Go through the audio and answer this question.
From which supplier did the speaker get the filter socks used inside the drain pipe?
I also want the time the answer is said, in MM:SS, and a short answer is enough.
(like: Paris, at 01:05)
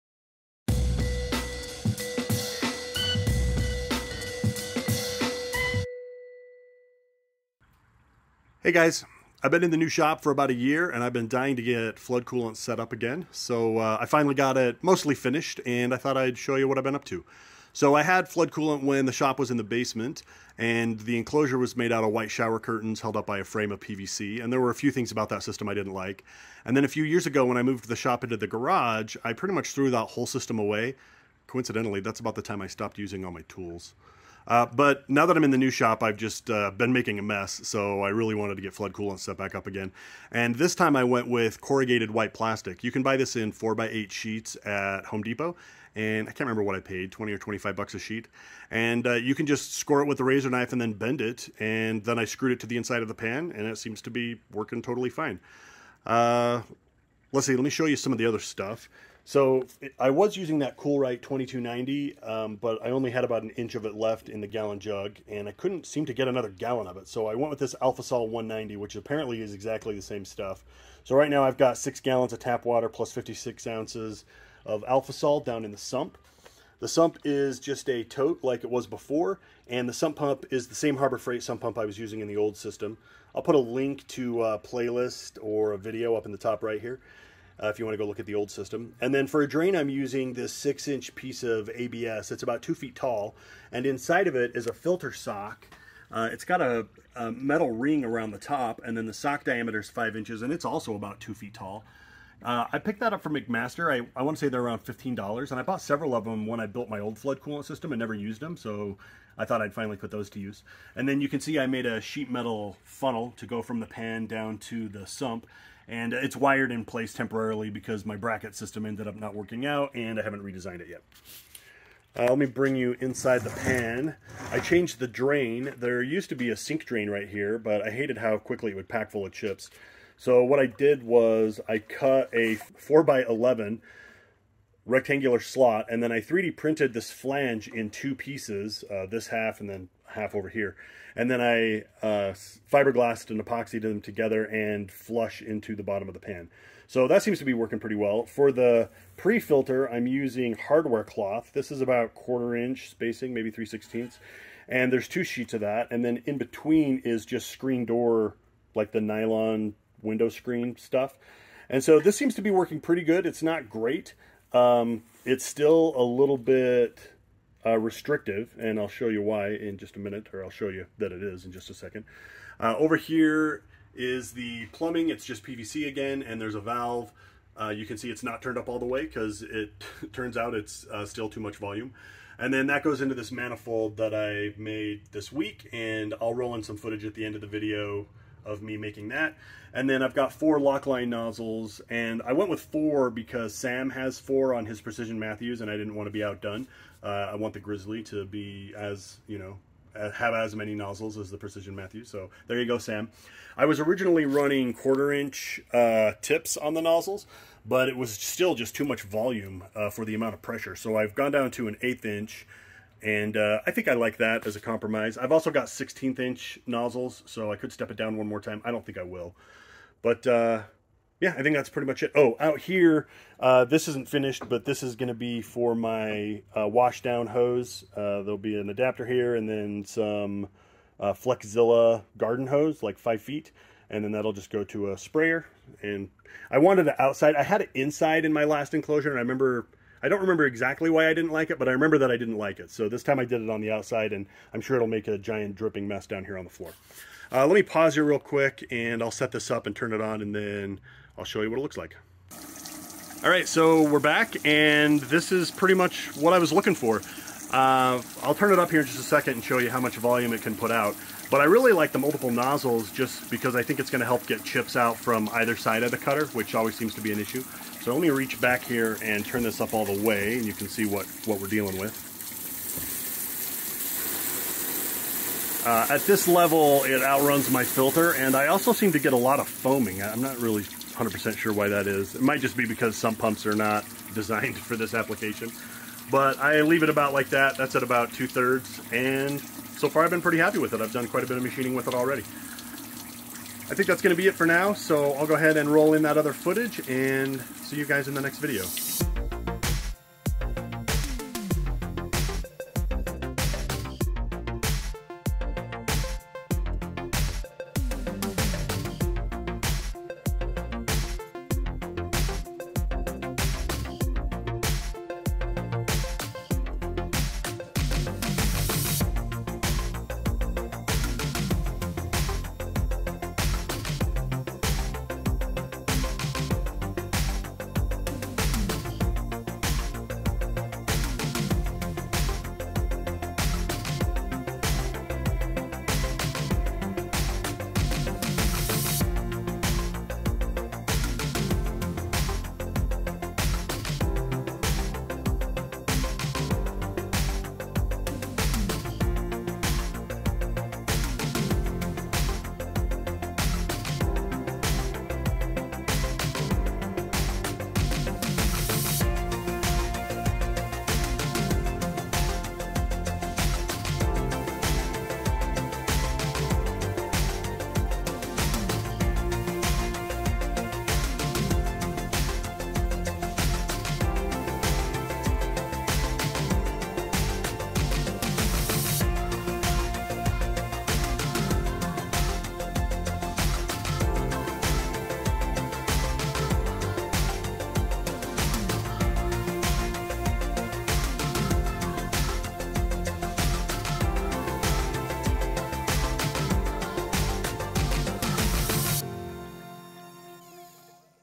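McMaster, at 01:43.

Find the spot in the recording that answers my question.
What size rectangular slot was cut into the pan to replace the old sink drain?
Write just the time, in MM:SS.
02:12.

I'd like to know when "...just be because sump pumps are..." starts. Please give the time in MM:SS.
04:42.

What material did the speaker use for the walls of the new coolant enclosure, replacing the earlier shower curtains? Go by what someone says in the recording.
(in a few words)
Corrugated white plastic.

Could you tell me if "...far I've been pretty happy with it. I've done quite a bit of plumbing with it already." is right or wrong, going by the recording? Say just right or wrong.
wrong.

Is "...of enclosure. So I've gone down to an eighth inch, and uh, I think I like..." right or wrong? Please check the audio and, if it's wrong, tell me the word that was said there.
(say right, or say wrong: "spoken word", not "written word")
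wrong: "pressure", not "enclosure".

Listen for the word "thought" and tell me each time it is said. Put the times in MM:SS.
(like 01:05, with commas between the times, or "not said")
00:15, 01:49.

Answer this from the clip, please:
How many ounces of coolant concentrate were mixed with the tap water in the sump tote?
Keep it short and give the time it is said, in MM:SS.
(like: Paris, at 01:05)
56, at 01:13.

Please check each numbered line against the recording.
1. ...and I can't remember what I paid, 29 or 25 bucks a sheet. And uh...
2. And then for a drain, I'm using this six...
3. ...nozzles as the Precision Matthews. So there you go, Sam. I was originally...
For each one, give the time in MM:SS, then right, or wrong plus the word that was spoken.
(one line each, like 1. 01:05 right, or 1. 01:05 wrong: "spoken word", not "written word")
1. 00:45 wrong: "20", not "29"
2. 01:29 right
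3. 03:20 right.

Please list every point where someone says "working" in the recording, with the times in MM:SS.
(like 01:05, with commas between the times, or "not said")
00:54, 01:59, 02:27, 02:42.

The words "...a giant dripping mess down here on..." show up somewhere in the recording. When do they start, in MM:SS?
04:05.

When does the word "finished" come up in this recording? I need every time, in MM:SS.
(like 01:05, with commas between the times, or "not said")
00:15, 03:44.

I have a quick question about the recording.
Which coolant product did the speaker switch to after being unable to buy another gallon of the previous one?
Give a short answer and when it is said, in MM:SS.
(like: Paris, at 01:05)
AlphaSol 190, at 01:07.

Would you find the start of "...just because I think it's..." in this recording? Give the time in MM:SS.
04:22.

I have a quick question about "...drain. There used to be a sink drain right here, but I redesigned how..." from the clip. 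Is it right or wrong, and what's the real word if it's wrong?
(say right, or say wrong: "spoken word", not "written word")
wrong: "hated", not "redesigned".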